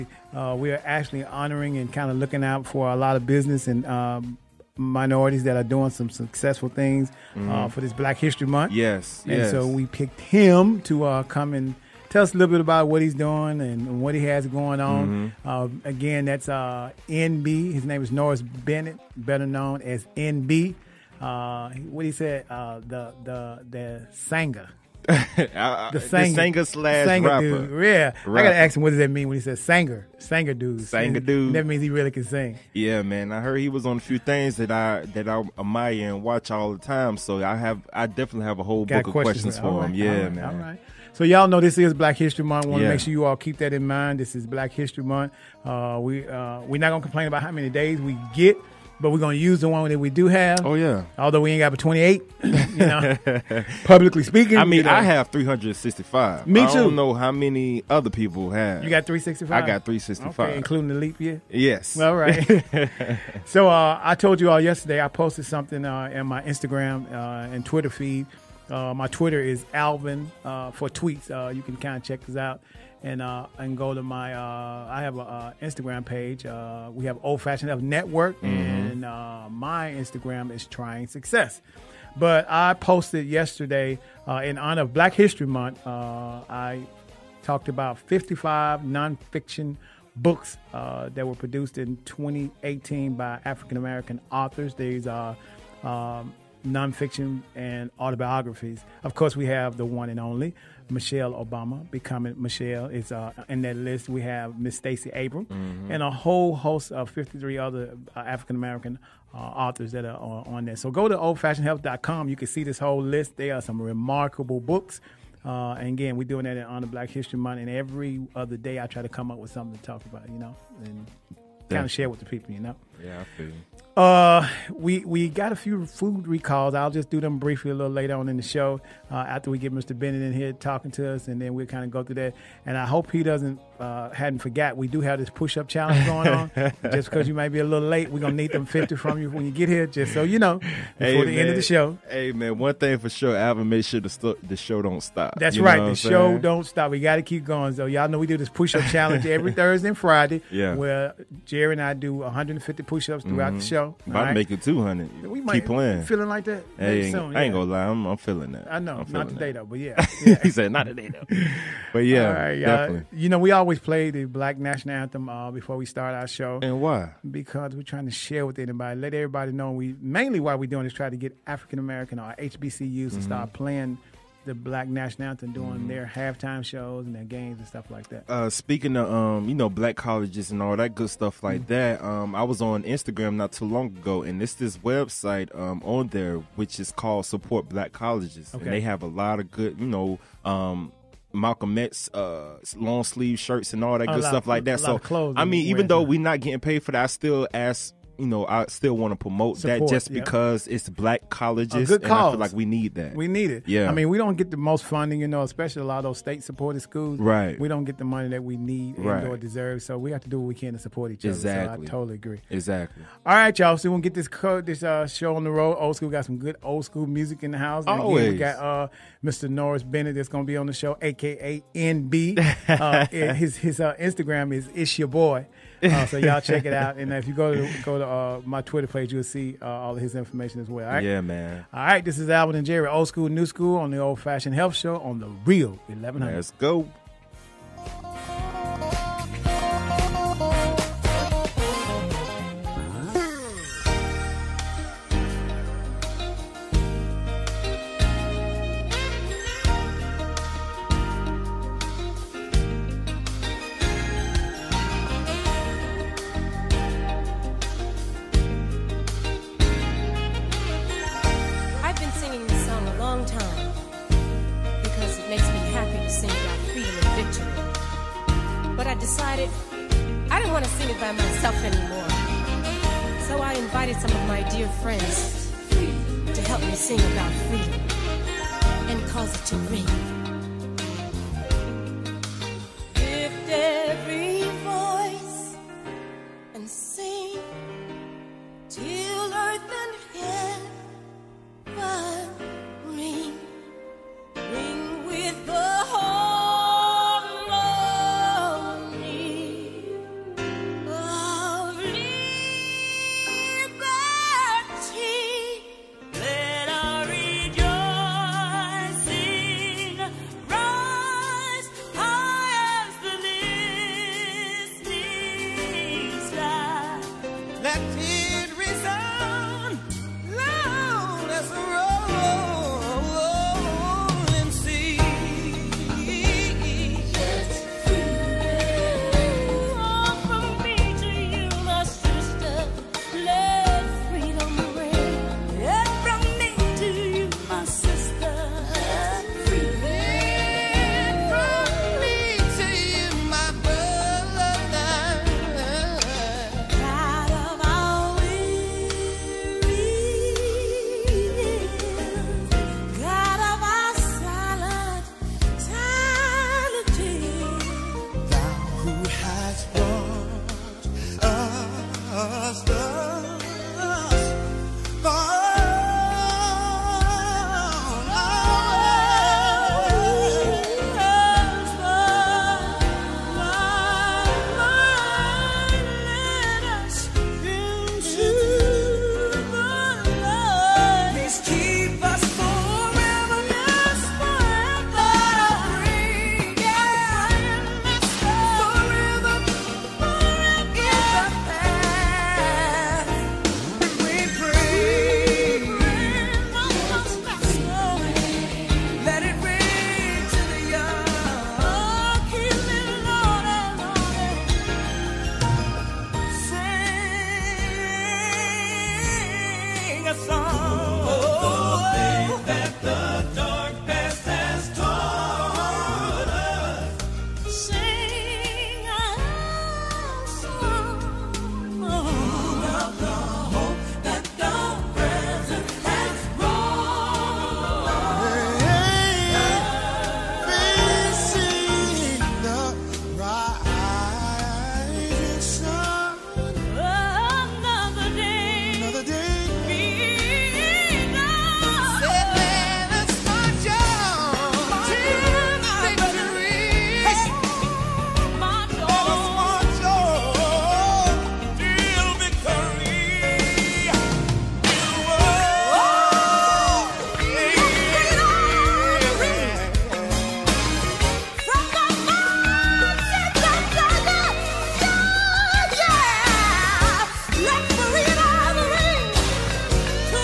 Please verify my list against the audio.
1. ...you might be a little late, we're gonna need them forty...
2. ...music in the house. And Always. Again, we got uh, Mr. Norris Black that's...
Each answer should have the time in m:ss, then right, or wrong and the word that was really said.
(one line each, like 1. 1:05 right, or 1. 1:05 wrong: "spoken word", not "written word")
1. 2:17 wrong: "fifty", not "forty"
2. 3:37 wrong: "Bennett", not "Black".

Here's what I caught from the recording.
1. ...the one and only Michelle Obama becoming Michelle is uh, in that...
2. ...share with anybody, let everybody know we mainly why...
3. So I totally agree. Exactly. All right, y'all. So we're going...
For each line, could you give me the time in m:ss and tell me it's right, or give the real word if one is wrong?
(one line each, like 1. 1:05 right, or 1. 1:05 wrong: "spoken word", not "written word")
1. 1:39 right
2. 2:48 right
3. 3:31 right.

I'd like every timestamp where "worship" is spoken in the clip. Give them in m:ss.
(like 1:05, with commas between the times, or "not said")
not said.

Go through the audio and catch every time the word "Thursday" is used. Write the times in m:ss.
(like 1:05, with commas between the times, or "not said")
2:29.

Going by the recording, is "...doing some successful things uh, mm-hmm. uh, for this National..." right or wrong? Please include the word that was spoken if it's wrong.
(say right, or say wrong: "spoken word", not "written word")
wrong: "Black", not "National".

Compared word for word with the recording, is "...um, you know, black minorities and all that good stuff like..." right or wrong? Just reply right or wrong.
wrong.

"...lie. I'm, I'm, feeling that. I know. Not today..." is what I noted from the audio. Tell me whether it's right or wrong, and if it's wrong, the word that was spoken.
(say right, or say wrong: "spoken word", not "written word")
right.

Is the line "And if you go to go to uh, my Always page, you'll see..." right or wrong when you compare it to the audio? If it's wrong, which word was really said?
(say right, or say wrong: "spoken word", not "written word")
wrong: "Twitter", not "Always".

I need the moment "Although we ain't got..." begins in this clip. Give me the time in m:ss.
0:51.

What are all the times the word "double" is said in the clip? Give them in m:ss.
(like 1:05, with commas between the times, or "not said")
not said.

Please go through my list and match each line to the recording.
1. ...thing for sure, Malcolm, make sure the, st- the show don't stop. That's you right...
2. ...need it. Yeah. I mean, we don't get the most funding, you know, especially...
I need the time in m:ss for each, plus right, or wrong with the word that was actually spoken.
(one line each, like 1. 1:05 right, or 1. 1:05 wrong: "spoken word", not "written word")
1. 2:22 wrong: "Alvin", not "Malcolm"
2. 3:23 right.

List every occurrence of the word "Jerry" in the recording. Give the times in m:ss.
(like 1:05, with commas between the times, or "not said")
2:31, 3:52.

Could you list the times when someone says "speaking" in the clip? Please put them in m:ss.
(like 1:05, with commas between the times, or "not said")
0:54, 2:58.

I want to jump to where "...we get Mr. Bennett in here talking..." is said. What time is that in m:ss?
2:09.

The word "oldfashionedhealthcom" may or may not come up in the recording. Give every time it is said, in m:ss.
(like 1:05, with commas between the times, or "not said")
1:51.